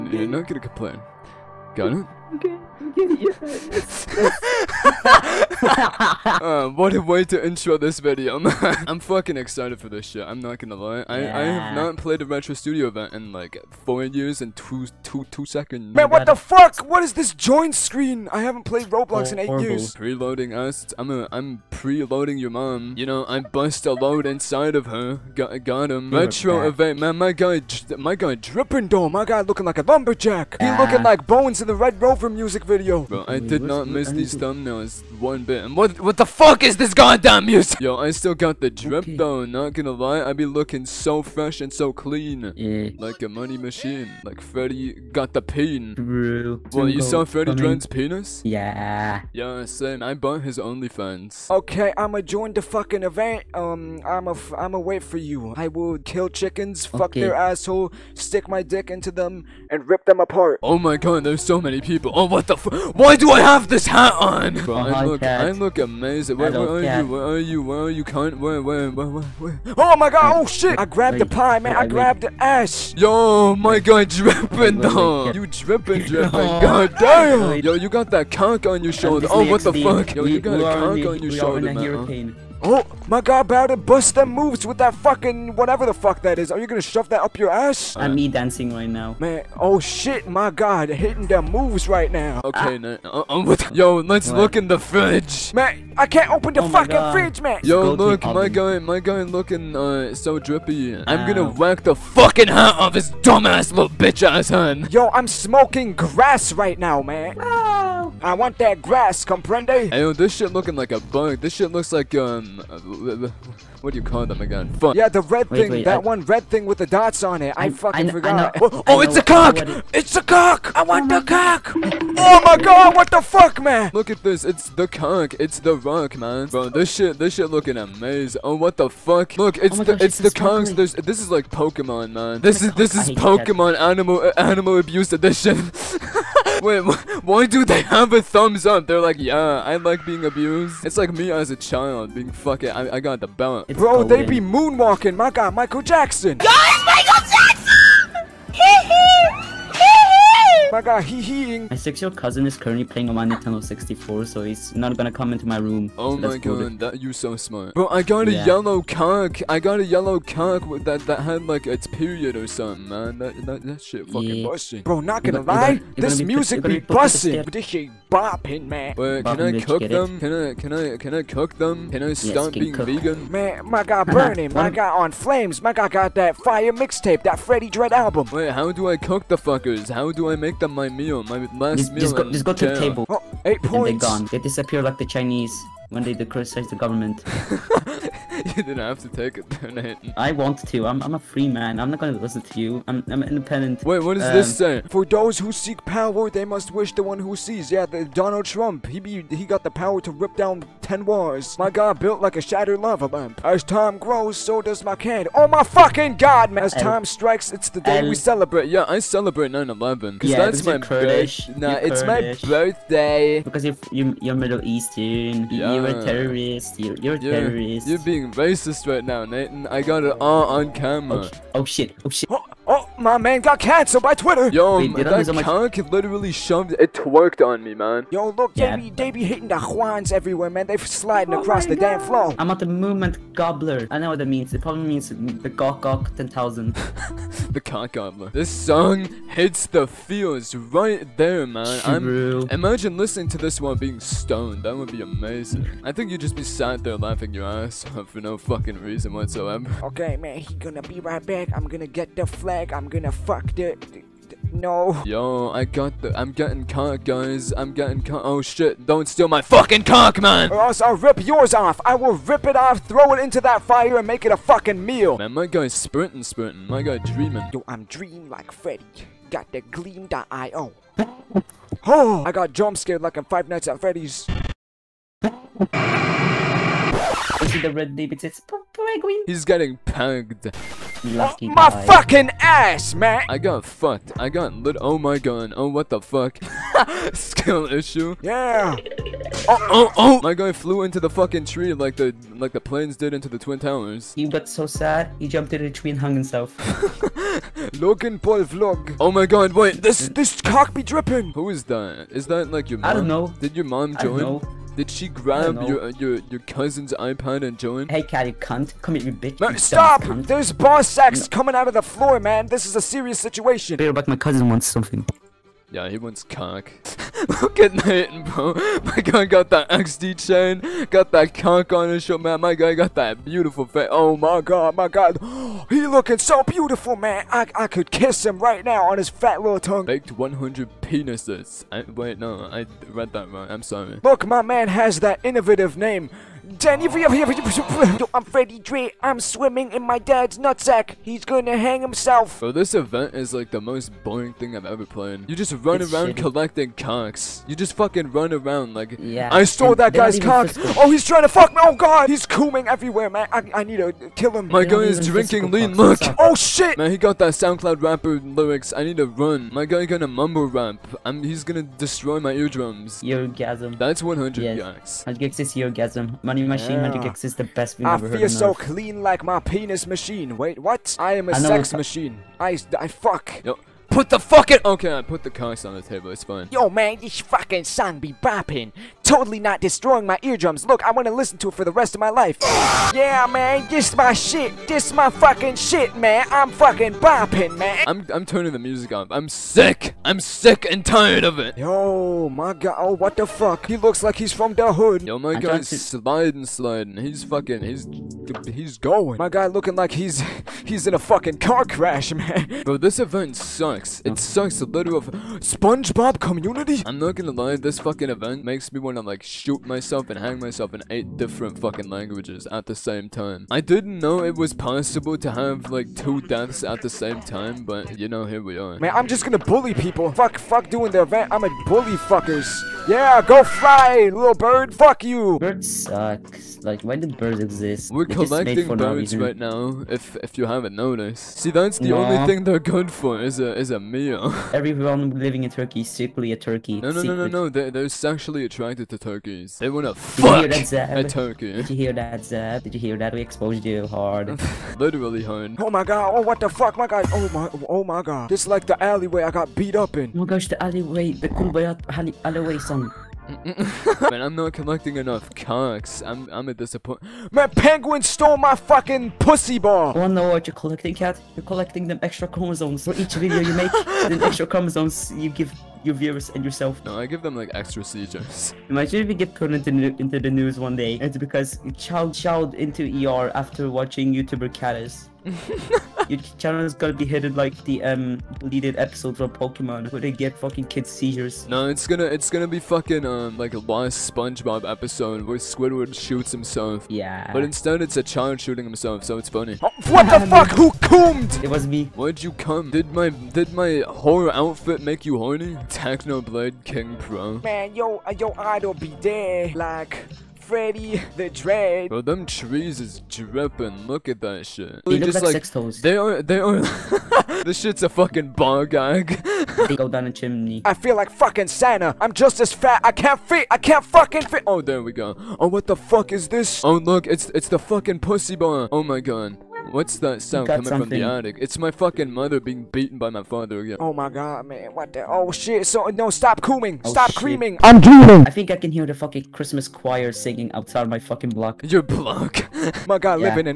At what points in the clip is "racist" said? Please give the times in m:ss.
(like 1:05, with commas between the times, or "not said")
3:38.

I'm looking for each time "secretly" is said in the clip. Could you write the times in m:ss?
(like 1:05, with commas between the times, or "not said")
7:15.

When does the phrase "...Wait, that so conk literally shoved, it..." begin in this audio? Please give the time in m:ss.
3:44.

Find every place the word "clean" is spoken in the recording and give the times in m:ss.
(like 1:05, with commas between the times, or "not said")
0:41, 6:08.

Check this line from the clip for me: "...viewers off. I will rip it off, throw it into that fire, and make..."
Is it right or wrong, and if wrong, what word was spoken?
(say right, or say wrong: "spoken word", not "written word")
wrong: "yours", not "viewers".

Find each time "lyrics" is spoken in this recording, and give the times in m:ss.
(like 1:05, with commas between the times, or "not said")
5:58.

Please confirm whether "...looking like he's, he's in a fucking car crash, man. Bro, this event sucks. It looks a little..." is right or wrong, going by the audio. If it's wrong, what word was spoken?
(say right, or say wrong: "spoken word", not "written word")
wrong: "sucks", not "looks".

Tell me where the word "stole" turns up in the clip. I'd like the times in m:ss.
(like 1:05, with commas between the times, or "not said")
5:49, 7:38.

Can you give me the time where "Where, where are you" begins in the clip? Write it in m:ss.
1:06.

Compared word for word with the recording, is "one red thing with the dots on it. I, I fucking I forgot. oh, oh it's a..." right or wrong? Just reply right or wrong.
right.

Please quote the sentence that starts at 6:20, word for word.
Look, I want to listen to it for the rest of my life.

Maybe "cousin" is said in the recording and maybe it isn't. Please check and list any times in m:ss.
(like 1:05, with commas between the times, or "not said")
2:32, 5:06, 5:14.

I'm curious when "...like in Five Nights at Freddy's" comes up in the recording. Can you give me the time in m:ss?
4:33.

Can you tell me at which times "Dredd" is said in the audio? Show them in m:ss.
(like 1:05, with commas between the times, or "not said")
0:47, 2:57.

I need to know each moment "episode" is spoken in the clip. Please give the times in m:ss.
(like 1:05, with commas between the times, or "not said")
7:58, 8:04.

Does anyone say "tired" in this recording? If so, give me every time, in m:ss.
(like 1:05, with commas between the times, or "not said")
6:30.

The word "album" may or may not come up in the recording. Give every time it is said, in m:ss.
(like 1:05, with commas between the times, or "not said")
2:57.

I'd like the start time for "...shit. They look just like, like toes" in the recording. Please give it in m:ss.
8:24.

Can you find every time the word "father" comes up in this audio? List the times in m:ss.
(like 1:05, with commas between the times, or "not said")
8:43.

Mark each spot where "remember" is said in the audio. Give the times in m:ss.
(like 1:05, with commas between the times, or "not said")
not said.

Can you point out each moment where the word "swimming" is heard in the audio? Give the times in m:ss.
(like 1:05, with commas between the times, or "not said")
5:39.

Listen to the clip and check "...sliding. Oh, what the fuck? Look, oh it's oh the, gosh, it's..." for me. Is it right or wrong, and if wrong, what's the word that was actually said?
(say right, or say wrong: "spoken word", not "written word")
wrong: "amazing", not "sliding".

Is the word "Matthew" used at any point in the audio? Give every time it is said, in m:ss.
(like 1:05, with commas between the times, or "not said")
not said.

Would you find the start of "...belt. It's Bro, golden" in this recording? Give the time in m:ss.
2:23.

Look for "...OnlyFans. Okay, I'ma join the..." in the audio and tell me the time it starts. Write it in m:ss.
0:50.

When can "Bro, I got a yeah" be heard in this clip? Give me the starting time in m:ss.
2:37.